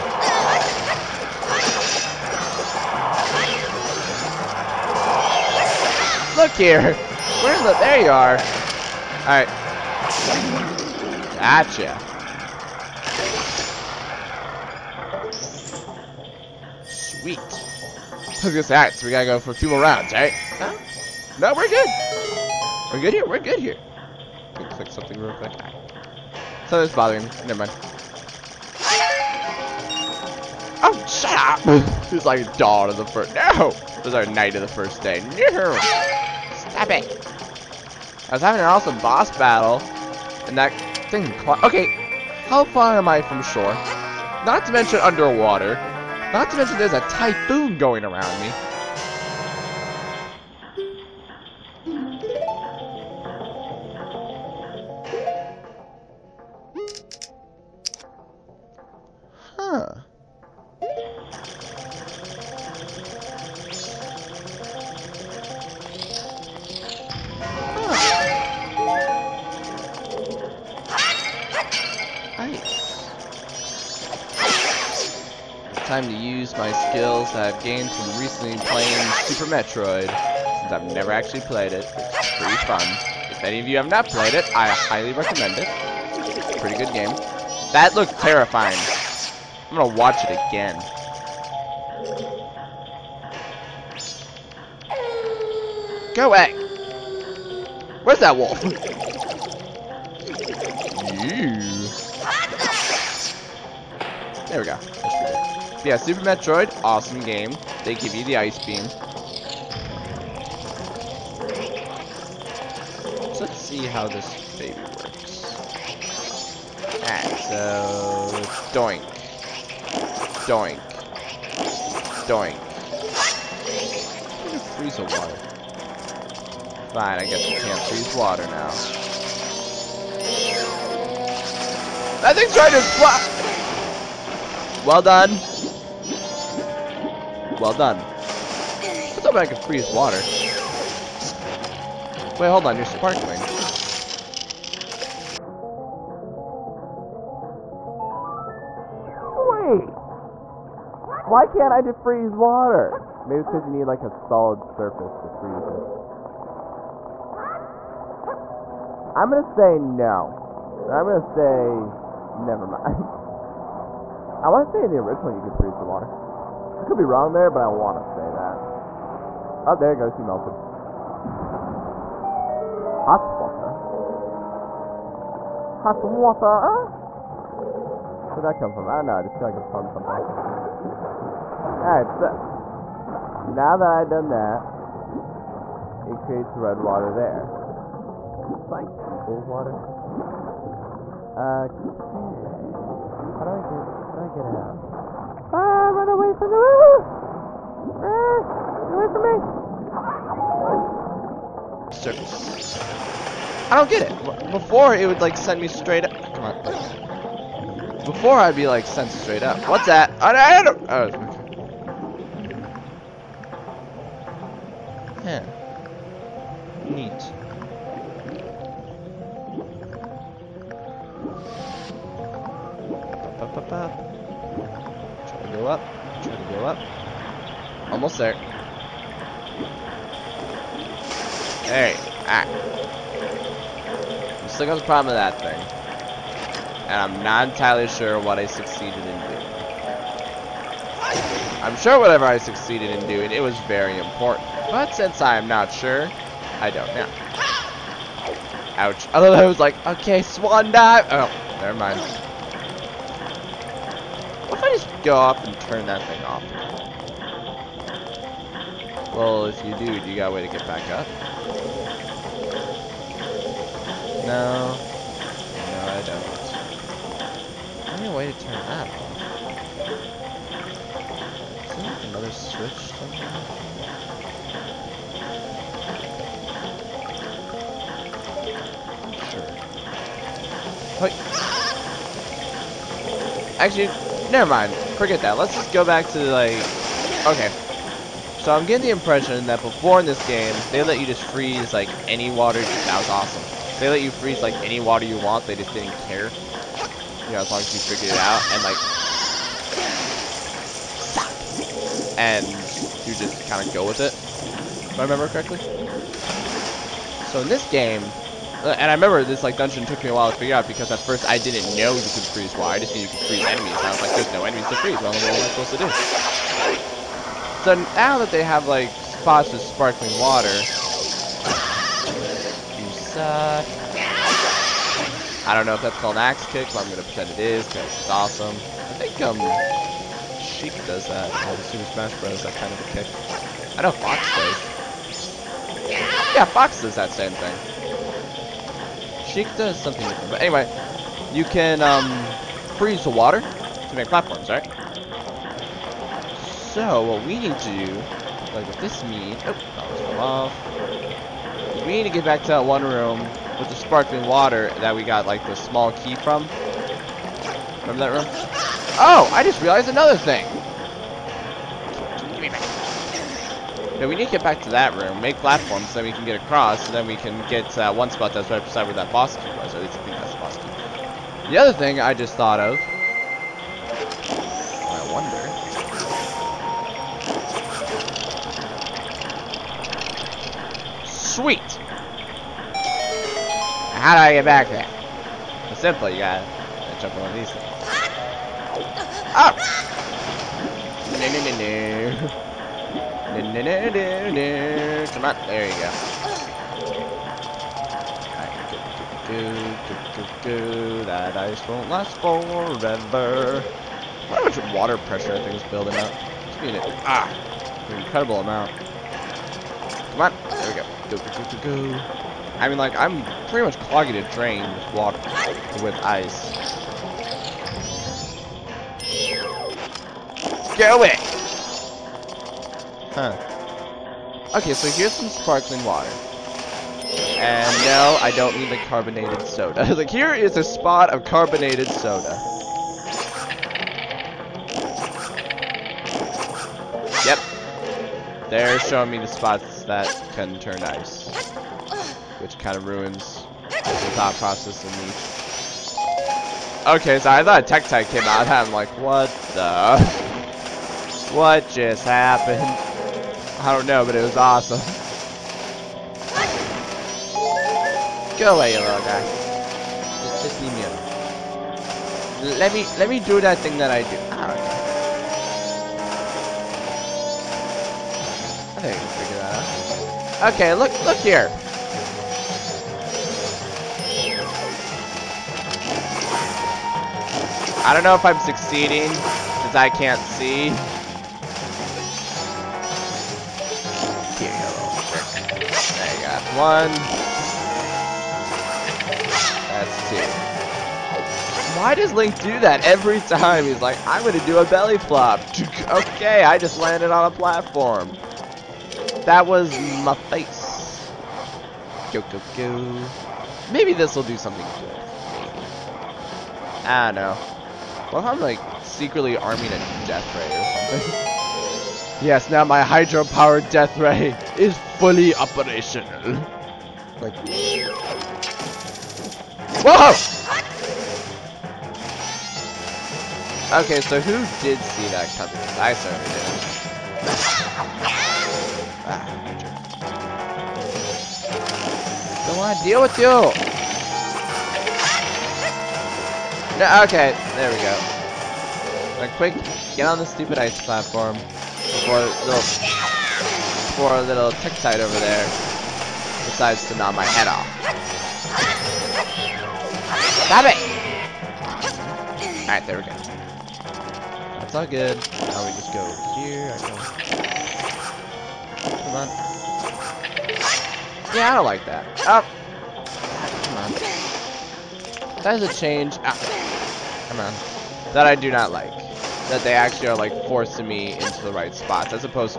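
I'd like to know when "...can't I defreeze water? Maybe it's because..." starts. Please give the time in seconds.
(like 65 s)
151 s.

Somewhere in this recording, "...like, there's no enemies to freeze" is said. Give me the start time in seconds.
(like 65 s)
314 s.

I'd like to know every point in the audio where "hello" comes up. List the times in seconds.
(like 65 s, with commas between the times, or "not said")
not said.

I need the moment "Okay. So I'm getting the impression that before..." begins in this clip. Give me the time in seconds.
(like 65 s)
287 s.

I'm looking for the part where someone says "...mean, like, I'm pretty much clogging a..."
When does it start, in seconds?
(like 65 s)
412 s.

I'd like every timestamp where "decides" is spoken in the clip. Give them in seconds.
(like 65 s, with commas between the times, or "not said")
546 s.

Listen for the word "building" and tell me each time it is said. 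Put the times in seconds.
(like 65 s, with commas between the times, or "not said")
405 s.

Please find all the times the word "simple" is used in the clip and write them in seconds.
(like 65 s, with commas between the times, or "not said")
385 s.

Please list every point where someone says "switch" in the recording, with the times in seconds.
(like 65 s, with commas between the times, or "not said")
272 s.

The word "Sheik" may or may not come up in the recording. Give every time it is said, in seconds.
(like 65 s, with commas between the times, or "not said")
330 s, 339 s.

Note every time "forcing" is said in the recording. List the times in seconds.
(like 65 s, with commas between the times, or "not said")
570 s.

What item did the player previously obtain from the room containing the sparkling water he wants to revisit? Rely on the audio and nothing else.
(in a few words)
small key.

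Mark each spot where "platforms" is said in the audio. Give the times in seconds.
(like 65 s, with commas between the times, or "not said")
344 s, 365 s, 497 s, 540 s.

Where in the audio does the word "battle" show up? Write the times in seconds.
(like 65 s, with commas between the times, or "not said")
39 s.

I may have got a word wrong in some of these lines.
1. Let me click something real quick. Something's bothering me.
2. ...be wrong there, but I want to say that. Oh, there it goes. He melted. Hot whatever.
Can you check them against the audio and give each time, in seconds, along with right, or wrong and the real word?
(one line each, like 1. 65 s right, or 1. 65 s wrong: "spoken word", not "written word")
1. 24 s right
2. 166 s wrong: "water", not "whatever".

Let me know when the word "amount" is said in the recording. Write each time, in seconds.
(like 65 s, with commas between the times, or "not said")
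408 s.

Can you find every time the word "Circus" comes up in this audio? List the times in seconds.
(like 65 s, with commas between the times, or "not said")
201 s.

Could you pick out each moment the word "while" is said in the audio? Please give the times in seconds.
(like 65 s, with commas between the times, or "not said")
310 s.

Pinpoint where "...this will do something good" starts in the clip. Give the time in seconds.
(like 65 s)
503 s.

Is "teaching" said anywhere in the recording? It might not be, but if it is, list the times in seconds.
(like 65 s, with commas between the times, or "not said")
not said.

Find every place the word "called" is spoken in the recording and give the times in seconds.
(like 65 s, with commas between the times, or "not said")
325 s.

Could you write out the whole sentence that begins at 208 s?
Before, I'd be, like, sent straight up.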